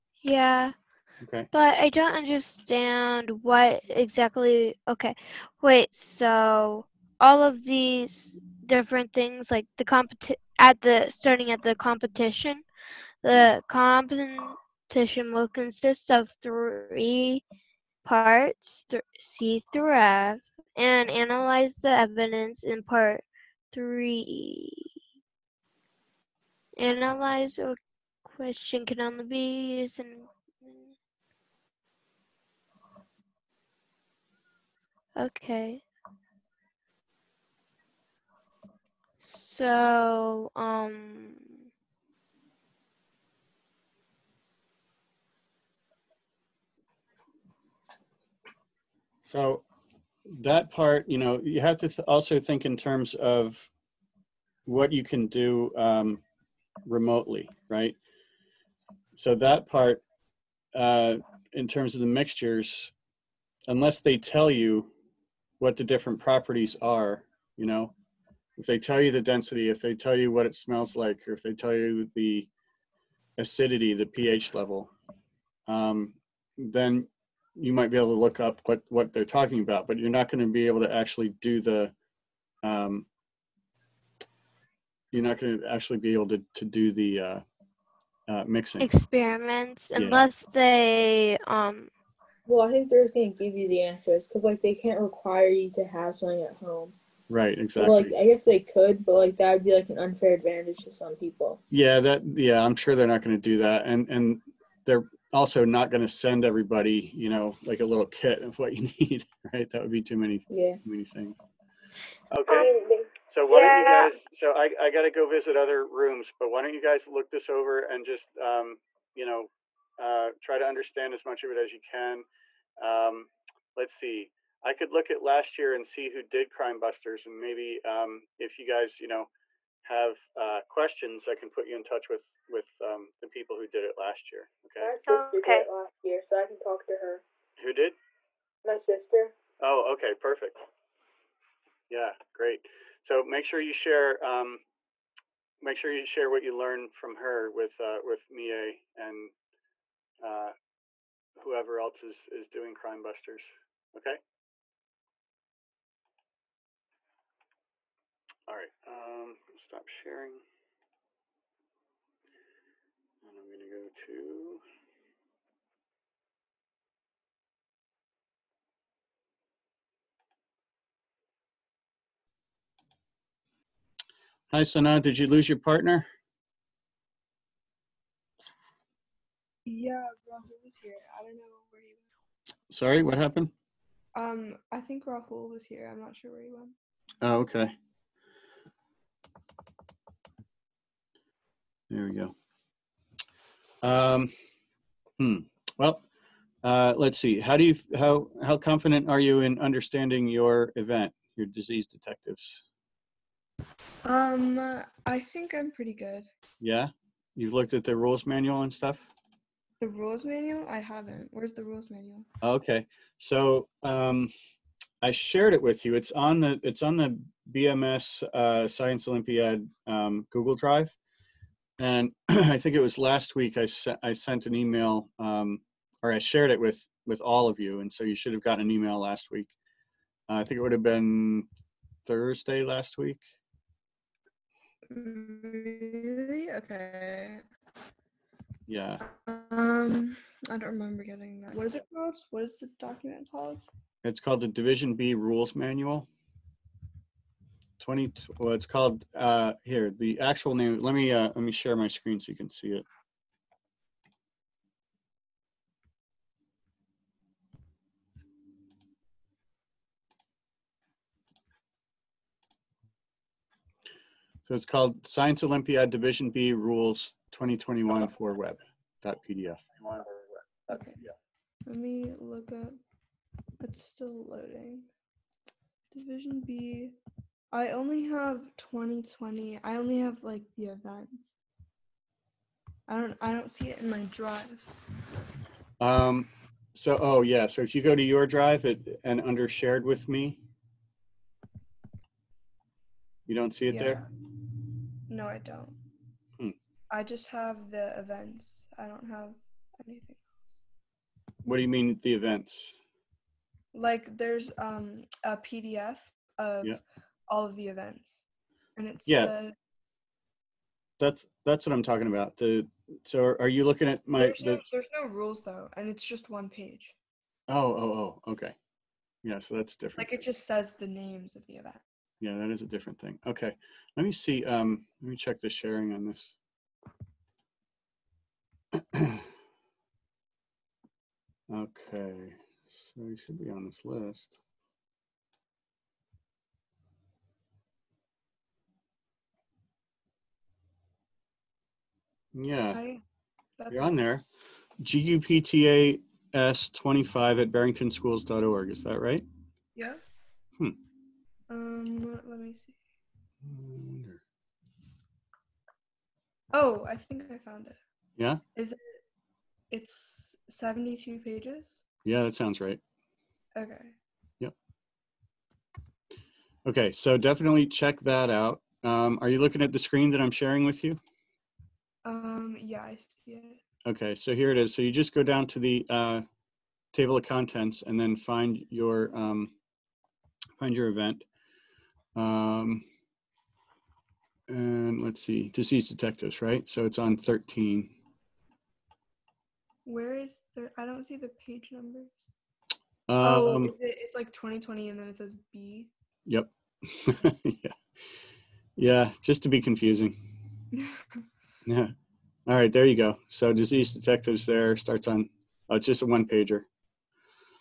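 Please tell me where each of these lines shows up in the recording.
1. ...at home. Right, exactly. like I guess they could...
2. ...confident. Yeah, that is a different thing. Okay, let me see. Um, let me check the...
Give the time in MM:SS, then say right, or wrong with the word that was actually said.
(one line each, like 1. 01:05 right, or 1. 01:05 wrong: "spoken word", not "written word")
1. 01:36 right
2. 05:21 wrong: "event", not "confident".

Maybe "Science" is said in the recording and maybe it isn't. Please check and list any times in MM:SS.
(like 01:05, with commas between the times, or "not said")
03:38, 04:25.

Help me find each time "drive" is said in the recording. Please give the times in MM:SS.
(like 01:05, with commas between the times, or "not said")
03:40, 04:44, 04:48.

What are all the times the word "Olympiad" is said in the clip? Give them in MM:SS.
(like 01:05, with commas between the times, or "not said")
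03:39, 04:25.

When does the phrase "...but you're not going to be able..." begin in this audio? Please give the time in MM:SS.
01:19.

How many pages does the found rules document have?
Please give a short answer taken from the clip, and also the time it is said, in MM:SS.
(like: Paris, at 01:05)
72, at 06:00.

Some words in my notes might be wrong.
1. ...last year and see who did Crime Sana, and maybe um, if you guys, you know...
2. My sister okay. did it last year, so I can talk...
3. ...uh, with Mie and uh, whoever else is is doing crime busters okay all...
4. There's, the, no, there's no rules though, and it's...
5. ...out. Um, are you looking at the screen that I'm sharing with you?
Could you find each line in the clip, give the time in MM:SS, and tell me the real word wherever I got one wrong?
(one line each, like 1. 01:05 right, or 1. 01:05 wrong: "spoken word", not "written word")
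1. 02:05 wrong: "Busters", not "Sana"
2. 02:14 right
3. 02:27 right
4. 05:14 right
5. 06:08 right.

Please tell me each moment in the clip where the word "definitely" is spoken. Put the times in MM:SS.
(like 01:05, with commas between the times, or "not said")
06:07.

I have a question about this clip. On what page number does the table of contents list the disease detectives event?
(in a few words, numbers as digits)
13.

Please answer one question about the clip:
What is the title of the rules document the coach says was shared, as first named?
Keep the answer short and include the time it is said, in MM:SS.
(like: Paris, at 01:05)
Division B Rules Manual, at 04:04.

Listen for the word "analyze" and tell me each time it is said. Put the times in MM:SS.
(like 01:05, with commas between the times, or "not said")
00:21, 00:26.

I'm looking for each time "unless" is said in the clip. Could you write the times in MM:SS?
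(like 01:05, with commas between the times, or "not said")
01:03, 01:29.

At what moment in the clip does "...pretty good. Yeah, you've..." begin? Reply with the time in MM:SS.
03:25.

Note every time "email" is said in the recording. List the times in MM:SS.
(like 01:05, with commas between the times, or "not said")
03:44, 03:48.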